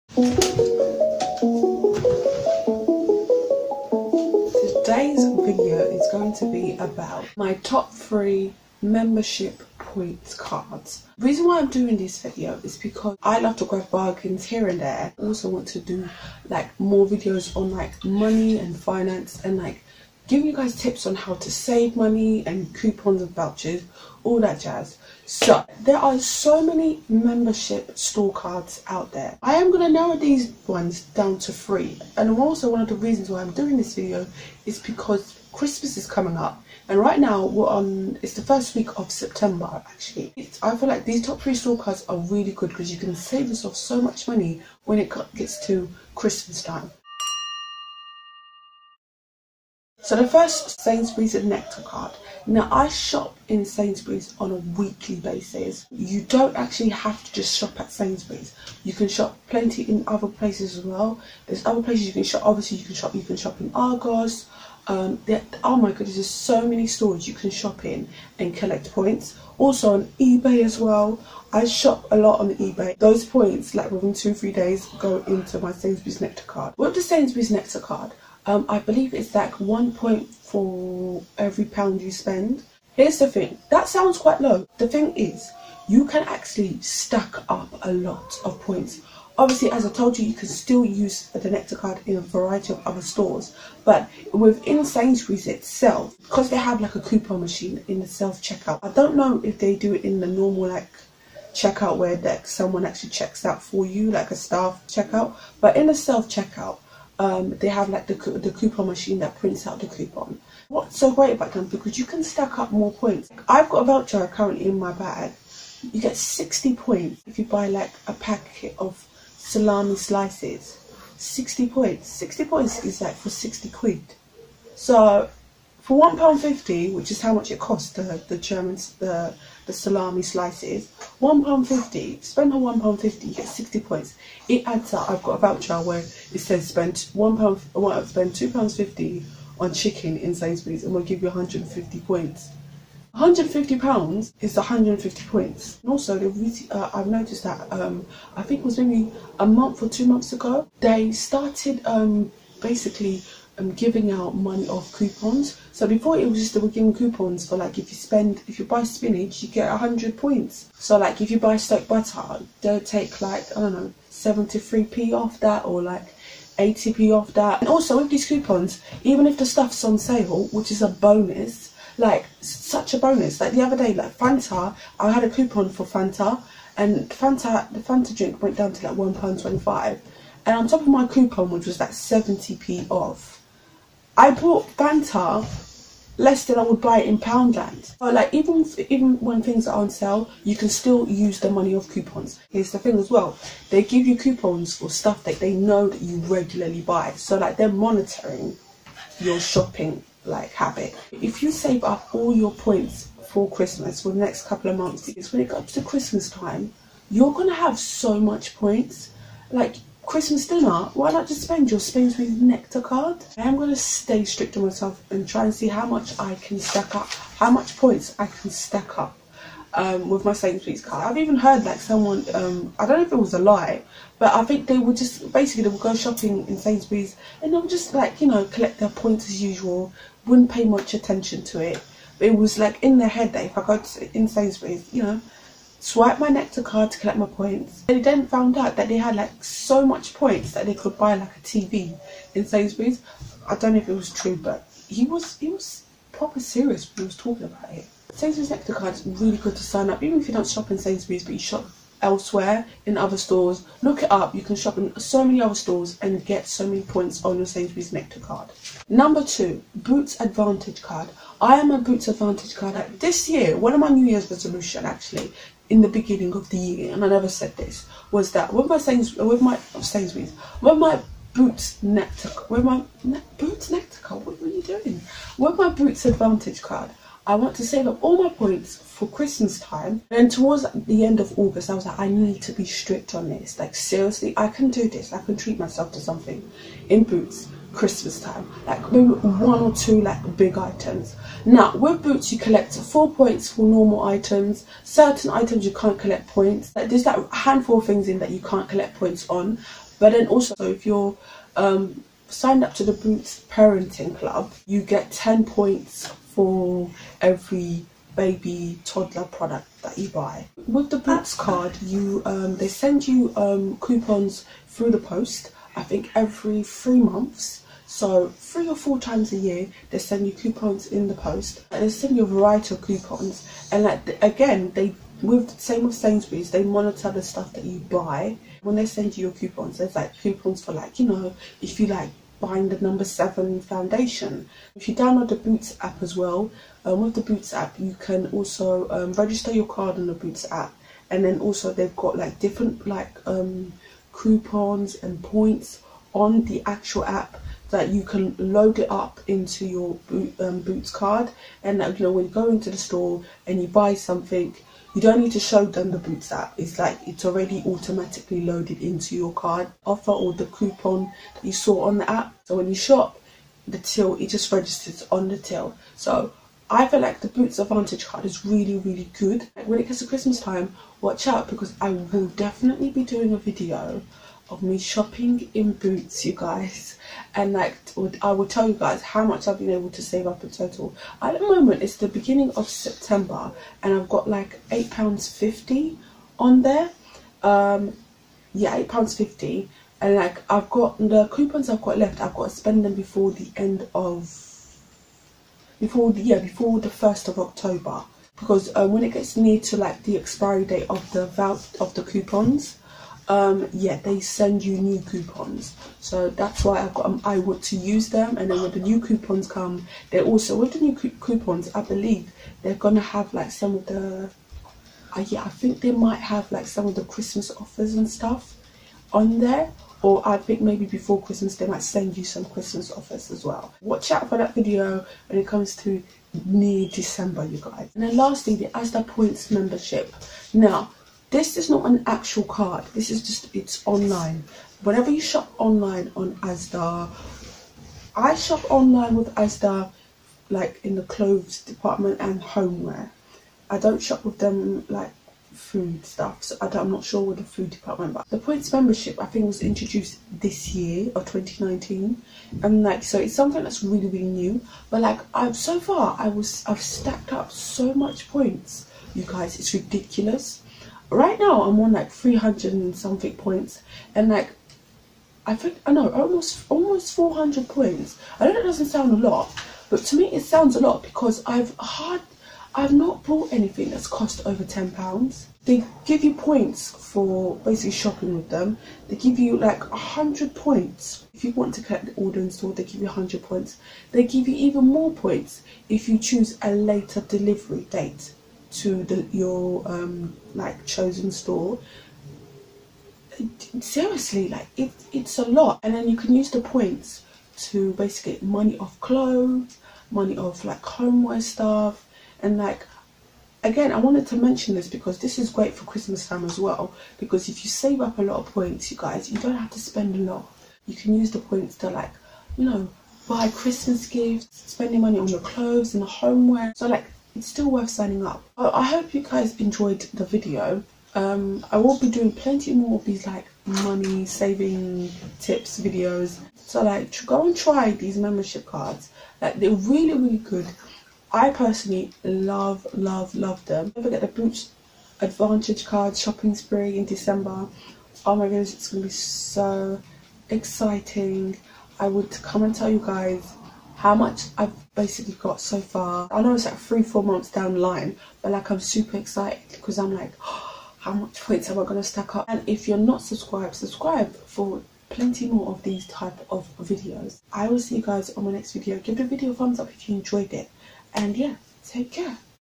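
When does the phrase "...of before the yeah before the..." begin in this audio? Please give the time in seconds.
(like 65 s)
393 s.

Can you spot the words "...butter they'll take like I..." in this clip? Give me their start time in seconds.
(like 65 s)
161 s.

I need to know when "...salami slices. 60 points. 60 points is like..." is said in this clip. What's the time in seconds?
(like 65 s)
119 s.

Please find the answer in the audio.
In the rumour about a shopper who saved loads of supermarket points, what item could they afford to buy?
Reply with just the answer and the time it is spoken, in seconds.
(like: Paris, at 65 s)
A TV, at 241 s.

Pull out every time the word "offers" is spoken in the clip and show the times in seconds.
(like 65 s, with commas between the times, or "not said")
359 s, 417 s, 422 s.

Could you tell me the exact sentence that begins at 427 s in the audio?
And then lastly the Asda Points membership.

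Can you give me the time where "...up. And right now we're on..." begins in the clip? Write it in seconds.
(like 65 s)
36 s.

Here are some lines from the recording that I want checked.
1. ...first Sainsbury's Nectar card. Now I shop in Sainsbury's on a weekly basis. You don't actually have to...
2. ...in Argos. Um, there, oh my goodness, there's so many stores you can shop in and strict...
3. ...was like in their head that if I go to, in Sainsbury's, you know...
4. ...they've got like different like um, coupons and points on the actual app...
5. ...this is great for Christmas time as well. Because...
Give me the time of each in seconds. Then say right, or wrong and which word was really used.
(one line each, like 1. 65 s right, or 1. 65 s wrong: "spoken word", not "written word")
1. 50 s right
2. 63 s wrong: "collect", not "strict"
3. 232 s right
4. 341 s right
5. 505 s right.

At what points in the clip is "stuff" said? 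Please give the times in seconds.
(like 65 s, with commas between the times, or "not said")
169 s, 194 s, 327 s, 418 s, 446 s, 501 s.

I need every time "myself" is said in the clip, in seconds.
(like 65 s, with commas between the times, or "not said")
214 s, 285 s.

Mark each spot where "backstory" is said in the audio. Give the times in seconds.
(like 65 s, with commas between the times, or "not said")
not said.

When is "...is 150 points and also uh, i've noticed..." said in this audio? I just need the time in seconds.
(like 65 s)
144 s.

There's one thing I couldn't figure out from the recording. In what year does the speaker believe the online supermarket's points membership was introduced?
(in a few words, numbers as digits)
2019.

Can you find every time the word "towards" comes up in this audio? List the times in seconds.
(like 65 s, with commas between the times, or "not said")
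280 s.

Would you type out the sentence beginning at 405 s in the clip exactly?
So that's why I got um, I want to use them.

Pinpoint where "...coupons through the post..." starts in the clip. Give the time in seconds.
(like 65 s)
313 s.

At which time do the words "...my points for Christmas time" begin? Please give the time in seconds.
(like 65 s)
278 s.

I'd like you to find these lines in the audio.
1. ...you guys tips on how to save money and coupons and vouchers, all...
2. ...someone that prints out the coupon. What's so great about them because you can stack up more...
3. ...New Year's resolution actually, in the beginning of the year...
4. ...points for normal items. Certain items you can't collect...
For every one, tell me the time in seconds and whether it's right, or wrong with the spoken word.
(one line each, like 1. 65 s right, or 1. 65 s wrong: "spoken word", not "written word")
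1. 20 s right
2. 108 s wrong: "machine", not "someone"
3. 263 s right
4. 293 s right.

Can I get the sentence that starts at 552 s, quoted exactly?
And if you're not subscribed, subscribe for plenty more of these type of videos.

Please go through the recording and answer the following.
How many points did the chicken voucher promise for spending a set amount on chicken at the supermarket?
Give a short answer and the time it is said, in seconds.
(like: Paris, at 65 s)
150, at 141 s.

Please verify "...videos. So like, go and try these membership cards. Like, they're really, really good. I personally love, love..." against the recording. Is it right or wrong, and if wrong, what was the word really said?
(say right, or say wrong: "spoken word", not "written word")
right.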